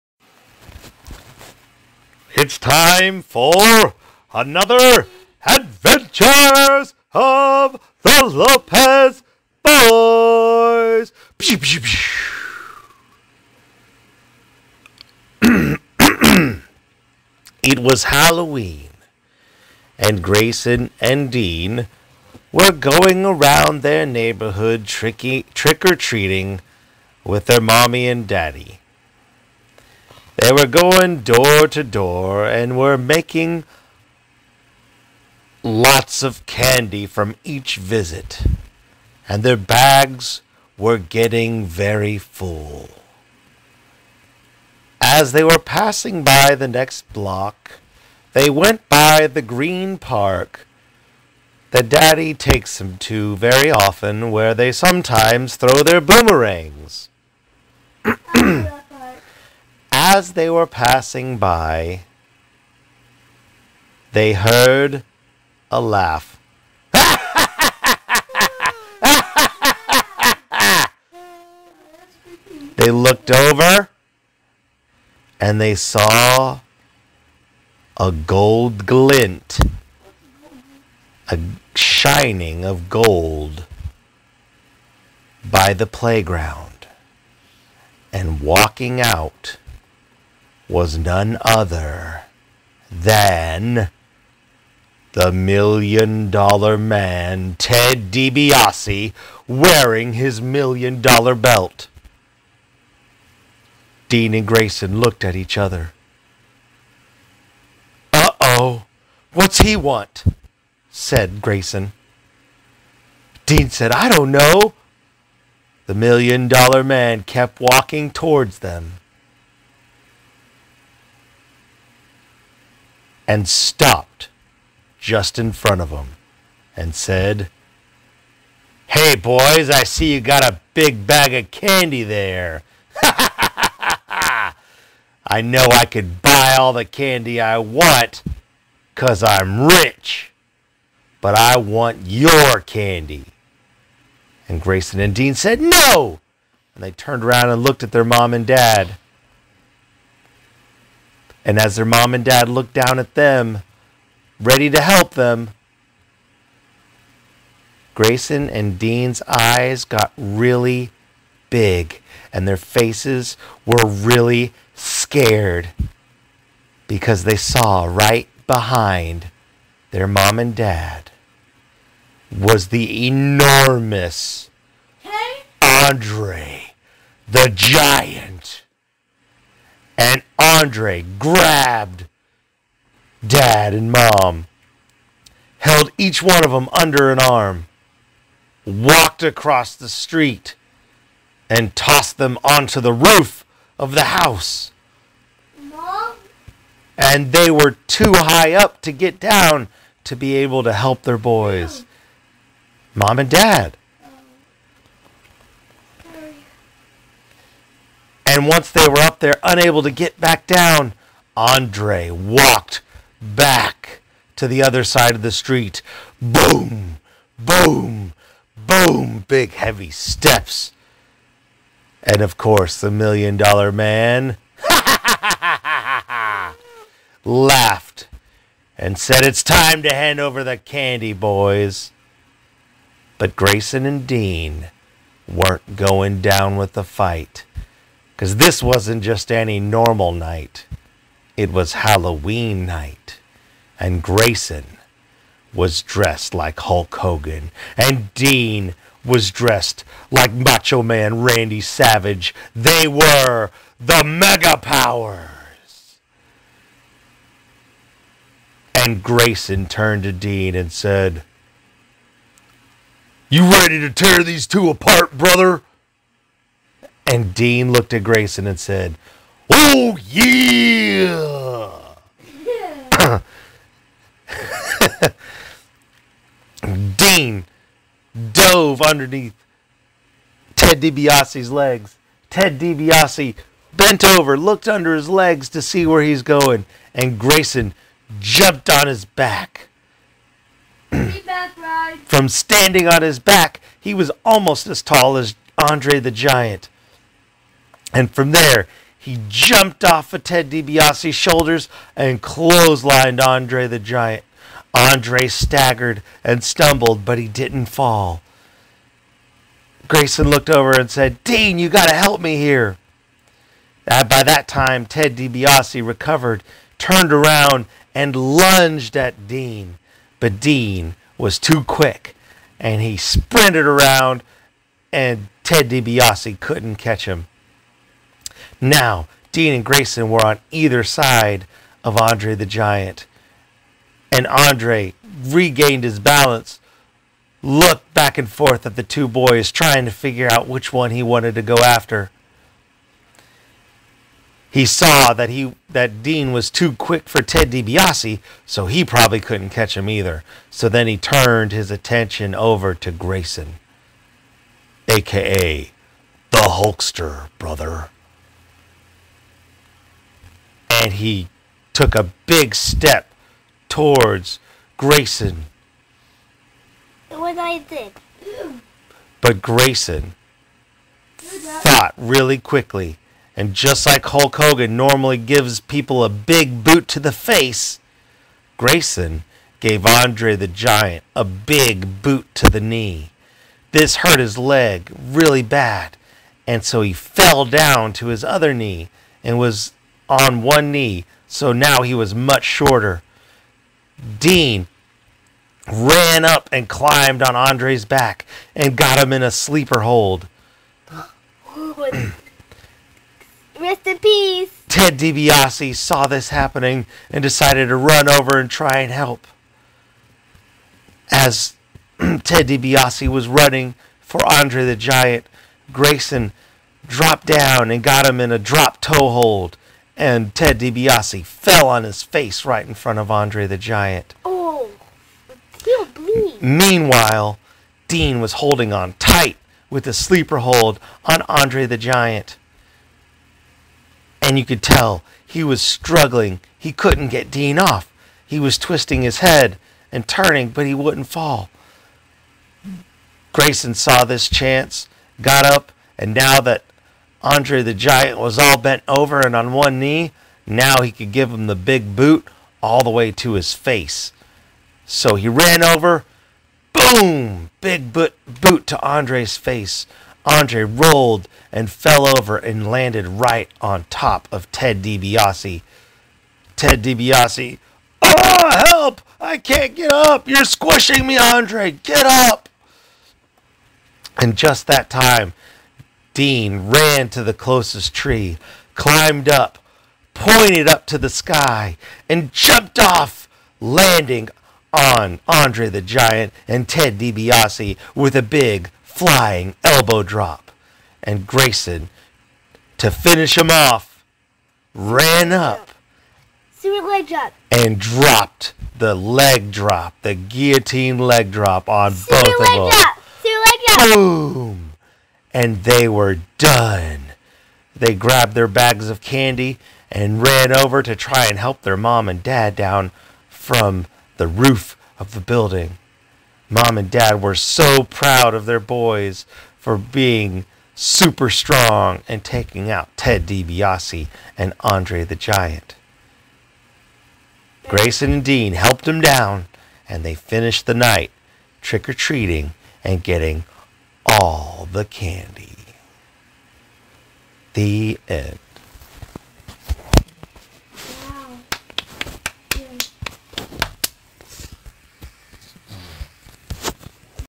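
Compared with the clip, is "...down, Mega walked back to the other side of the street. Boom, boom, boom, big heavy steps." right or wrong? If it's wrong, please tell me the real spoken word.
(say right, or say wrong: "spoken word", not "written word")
wrong: "Andre", not "Mega".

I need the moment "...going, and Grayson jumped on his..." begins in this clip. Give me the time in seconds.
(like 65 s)
286 s.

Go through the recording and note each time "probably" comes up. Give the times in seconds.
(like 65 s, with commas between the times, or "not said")
348 s.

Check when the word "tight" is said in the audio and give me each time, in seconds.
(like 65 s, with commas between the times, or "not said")
428 s.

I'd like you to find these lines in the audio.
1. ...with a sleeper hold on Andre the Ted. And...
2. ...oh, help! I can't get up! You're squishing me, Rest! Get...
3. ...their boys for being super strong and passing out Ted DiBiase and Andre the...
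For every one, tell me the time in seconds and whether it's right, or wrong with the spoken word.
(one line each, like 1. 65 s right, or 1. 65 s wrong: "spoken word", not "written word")
1. 429 s wrong: "Giant", not "Ted"
2. 468 s wrong: "Andre", not "Rest"
3. 518 s wrong: "taking", not "passing".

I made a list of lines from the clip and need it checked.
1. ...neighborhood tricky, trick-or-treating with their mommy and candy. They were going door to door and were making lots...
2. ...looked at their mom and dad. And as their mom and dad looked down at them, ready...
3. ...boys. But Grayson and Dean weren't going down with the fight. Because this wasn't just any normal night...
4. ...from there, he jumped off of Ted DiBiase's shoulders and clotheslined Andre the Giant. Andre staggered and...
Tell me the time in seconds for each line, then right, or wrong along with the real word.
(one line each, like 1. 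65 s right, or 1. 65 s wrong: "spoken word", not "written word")
1. 24 s wrong: "daddy", not "candy"
2. 147 s right
3. 231 s right
4. 298 s right.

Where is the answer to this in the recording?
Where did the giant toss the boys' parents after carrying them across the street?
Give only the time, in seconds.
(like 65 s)
192 s.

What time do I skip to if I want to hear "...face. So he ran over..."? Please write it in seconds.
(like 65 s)
453 s.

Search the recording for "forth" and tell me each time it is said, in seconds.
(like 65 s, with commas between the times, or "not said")
338 s.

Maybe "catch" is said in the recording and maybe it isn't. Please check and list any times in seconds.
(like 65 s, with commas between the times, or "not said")
326 s, 349 s.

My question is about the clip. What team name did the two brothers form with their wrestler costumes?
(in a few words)
The Mega Powers.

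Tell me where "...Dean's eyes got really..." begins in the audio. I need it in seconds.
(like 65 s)
158 s.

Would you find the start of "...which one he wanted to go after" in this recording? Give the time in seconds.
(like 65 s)
340 s.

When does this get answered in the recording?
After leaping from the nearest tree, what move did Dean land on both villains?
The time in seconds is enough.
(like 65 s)
488 s.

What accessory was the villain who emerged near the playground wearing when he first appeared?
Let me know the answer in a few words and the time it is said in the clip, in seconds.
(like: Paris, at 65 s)
Million dollar belt, at 100 s.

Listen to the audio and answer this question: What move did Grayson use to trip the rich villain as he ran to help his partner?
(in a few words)
Drop toe hold.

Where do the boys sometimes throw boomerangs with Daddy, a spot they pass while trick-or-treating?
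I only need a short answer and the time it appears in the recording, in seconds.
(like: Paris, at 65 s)
The green park, at 49 s.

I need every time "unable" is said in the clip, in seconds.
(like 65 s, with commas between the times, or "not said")
209 s.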